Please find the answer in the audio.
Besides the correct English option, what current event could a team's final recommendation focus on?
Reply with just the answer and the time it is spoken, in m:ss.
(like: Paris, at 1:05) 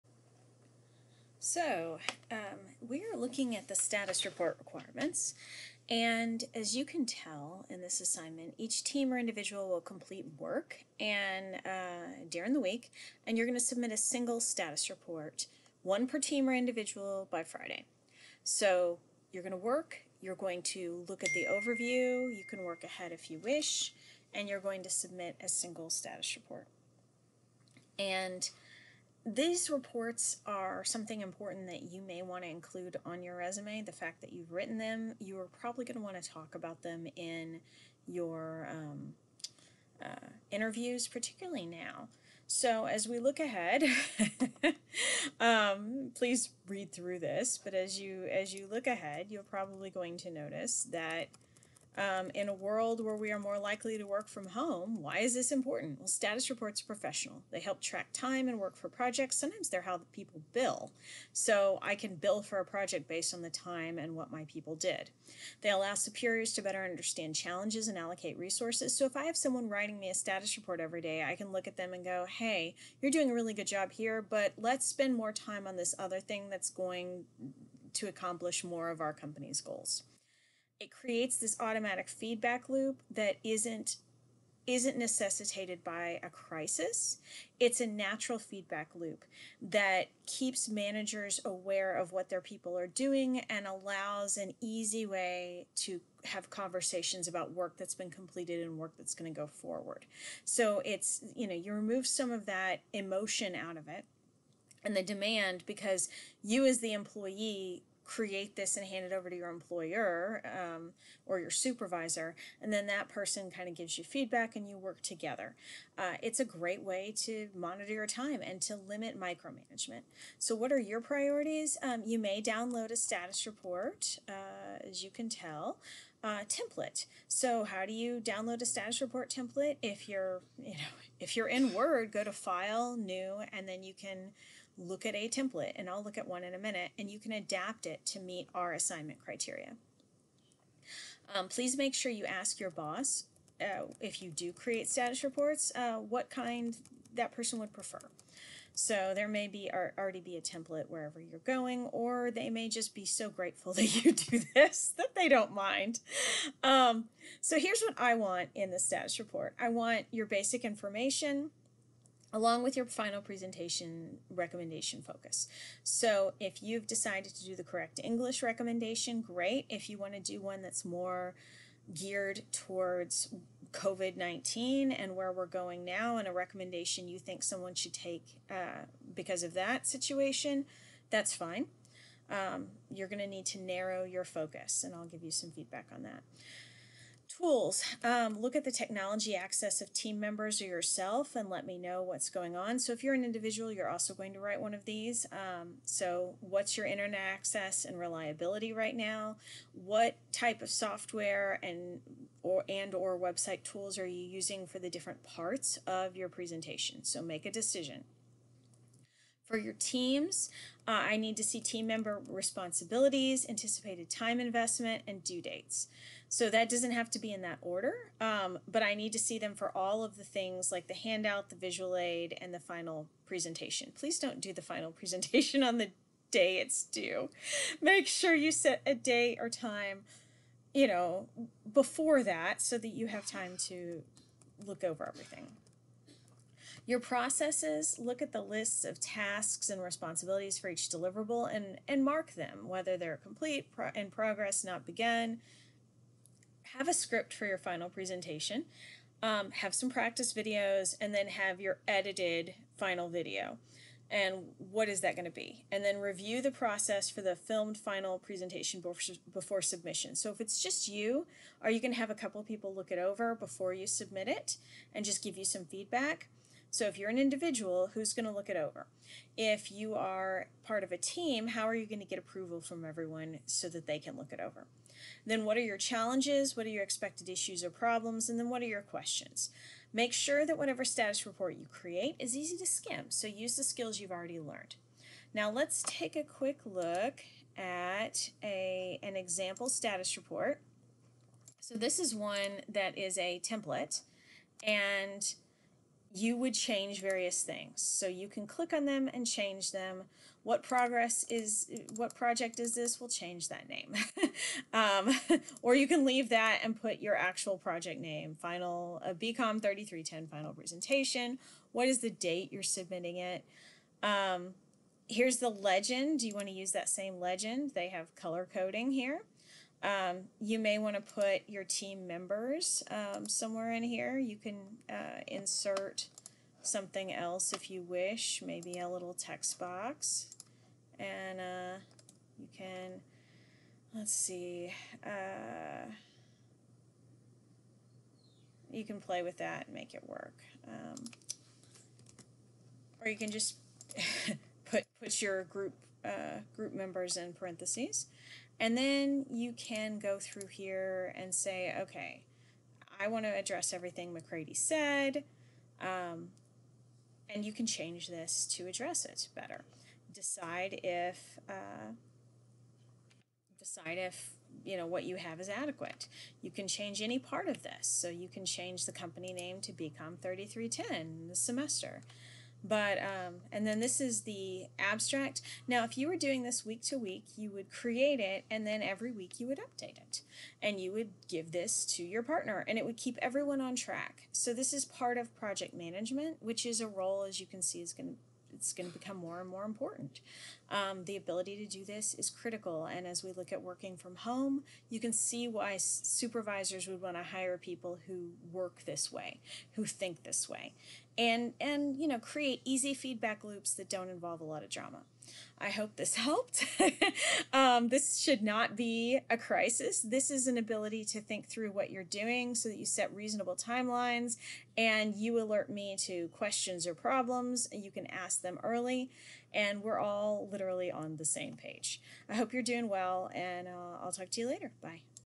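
COVID 19, at 2:53.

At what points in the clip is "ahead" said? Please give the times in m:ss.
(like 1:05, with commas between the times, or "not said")
0:22, 0:43, 0:48.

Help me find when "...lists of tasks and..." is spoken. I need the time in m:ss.
3:58.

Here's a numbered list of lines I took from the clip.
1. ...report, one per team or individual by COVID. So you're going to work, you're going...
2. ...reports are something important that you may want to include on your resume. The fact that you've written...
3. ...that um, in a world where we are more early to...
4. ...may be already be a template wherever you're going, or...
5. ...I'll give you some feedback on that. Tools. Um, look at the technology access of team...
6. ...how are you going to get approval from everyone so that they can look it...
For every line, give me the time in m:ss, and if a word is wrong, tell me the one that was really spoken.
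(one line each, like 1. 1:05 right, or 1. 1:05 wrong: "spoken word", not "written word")
1. 0:14 wrong: "Friday", not "COVID"
2. 0:29 right
3. 0:50 wrong: "likely", not "early"
4. 2:29 right
5. 3:04 right
6. 4:31 right.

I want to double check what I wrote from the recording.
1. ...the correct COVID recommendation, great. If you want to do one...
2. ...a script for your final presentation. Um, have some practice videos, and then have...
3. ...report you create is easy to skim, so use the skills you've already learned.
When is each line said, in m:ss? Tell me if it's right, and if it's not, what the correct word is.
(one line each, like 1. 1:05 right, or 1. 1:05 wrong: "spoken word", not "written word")
1. 2:47 wrong: "English", not "COVID"
2. 4:06 right
3. 4:41 right.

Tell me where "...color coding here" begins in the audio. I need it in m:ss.
5:18.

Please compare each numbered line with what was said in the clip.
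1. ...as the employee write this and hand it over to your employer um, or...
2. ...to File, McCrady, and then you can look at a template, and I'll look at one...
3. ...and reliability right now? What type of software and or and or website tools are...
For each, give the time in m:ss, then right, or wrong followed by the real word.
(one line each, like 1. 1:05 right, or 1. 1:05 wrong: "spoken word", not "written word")
1. 1:46 wrong: "create", not "write"
2. 2:12 wrong: "New", not "McCrady"
3. 3:17 right.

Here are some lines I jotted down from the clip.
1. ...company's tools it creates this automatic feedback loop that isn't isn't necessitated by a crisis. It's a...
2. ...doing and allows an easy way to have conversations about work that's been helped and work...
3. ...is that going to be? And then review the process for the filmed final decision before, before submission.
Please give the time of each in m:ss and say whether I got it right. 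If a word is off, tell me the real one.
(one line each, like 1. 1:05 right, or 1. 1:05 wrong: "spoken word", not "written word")
1. 1:19 wrong: "goals", not "tools"
2. 1:32 wrong: "completed", not "helped"
3. 4:14 wrong: "presentation", not "decision".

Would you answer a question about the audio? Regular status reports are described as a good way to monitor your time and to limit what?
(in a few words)
Micromanagement.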